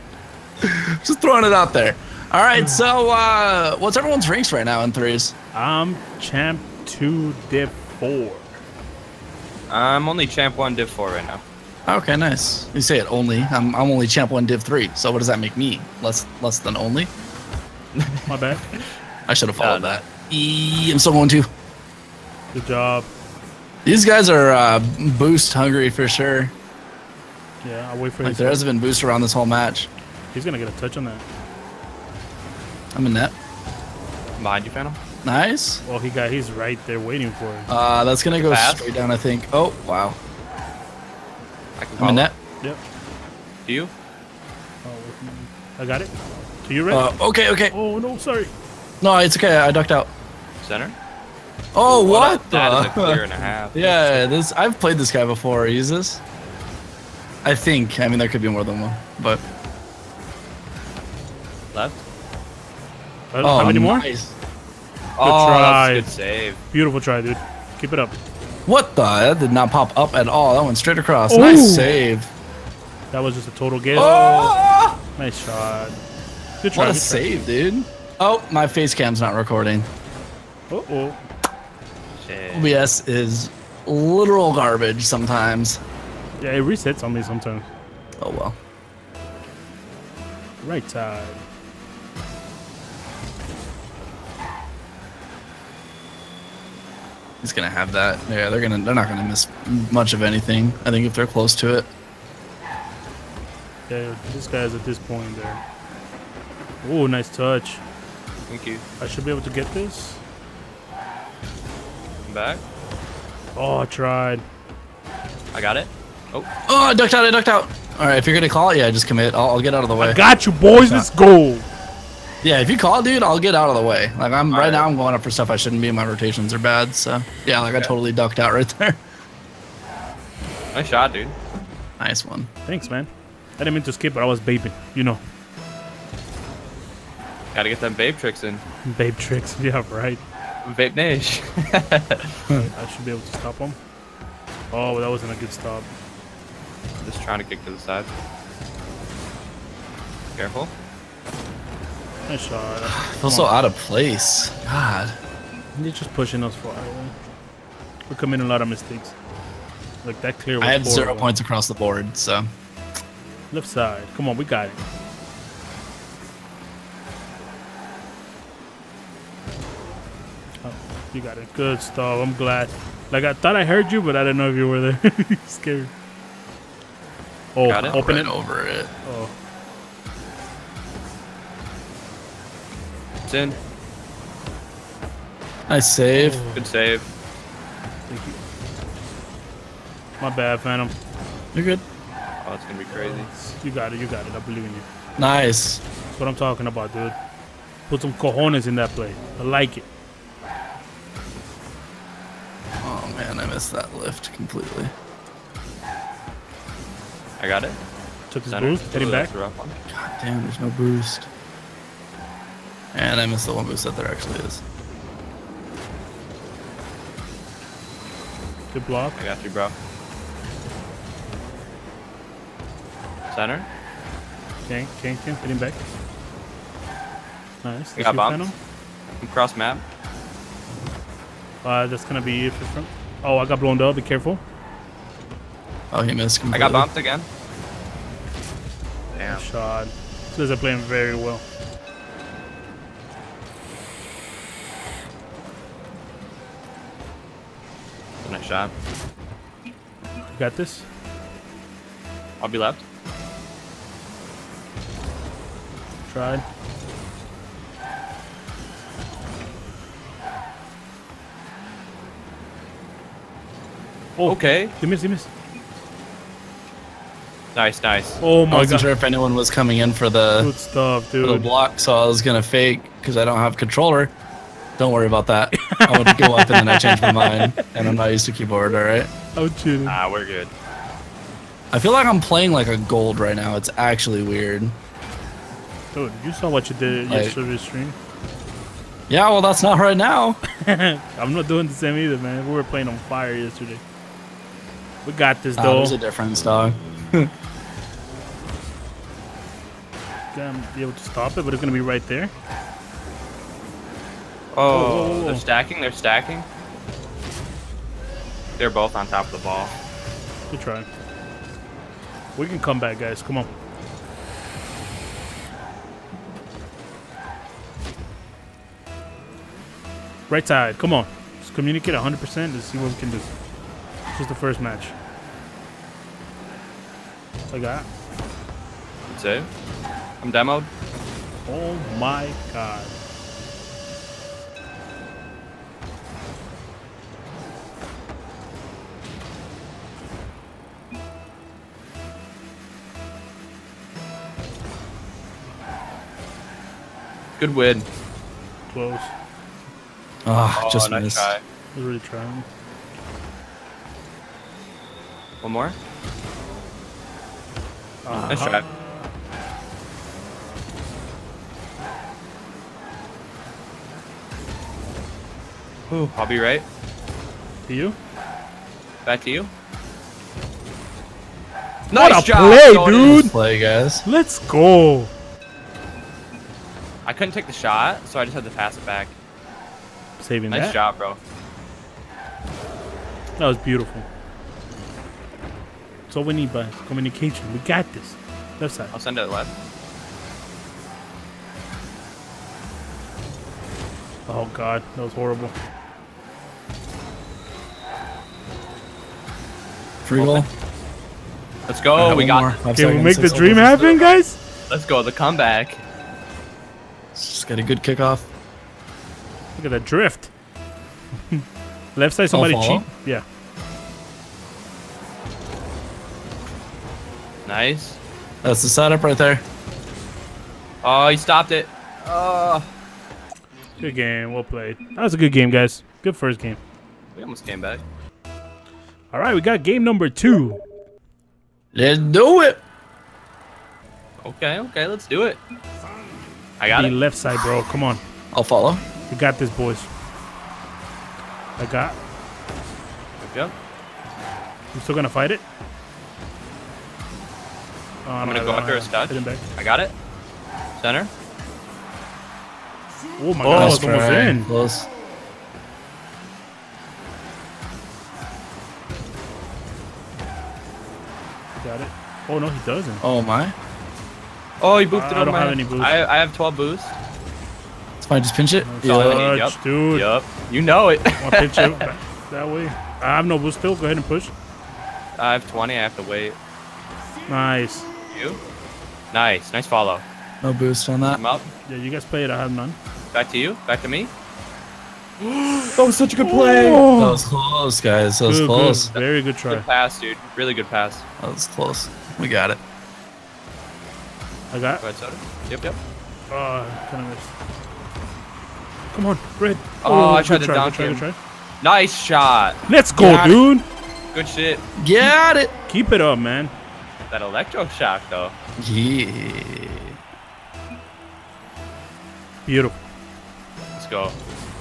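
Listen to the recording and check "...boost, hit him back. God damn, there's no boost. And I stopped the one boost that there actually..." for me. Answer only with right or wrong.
wrong.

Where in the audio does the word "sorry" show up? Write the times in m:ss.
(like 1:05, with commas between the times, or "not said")
0:48.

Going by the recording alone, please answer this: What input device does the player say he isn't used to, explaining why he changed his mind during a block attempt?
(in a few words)
Keyboard.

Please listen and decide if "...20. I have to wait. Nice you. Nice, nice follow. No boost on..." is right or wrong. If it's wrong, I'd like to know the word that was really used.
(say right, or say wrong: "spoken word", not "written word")
right.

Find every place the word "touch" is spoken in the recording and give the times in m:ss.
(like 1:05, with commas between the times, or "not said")
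0:30, 1:47, 7:28.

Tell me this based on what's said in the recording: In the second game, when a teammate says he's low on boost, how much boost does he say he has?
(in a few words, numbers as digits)
12.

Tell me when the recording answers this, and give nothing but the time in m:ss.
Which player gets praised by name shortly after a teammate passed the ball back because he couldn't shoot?
6:12.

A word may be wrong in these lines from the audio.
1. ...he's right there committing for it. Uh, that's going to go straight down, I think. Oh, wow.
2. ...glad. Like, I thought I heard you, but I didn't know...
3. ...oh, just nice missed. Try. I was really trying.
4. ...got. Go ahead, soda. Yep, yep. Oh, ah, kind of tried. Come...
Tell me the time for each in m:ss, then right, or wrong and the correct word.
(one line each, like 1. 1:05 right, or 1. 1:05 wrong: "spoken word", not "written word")
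1. 0:36 wrong: "waiting", not "committing"
2. 2:52 right
3. 5:50 right
4. 8:14 wrong: "missed", not "tried".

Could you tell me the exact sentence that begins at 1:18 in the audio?
Oh, my face cam's not recording.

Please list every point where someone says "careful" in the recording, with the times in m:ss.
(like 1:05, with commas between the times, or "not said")
2:30, 3:54.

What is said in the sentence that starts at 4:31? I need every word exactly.
the block, so I was gonna fake because I don't have controller.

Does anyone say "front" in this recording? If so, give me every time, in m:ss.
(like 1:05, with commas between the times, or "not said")
3:52.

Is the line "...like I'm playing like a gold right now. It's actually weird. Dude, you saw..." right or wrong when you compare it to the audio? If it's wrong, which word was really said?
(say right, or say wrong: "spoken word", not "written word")
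right.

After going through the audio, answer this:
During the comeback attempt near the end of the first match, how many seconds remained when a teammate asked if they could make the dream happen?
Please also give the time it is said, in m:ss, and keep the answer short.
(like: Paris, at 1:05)
6, at 6:43.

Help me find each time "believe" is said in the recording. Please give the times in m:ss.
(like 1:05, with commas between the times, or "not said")
3:14.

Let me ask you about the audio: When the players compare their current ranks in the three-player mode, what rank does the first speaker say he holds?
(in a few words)
Champ 2, Div 4.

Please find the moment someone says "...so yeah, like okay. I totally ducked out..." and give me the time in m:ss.
2:06.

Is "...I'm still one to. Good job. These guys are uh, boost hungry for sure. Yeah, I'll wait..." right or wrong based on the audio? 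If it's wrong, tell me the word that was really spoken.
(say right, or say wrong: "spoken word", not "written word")
right.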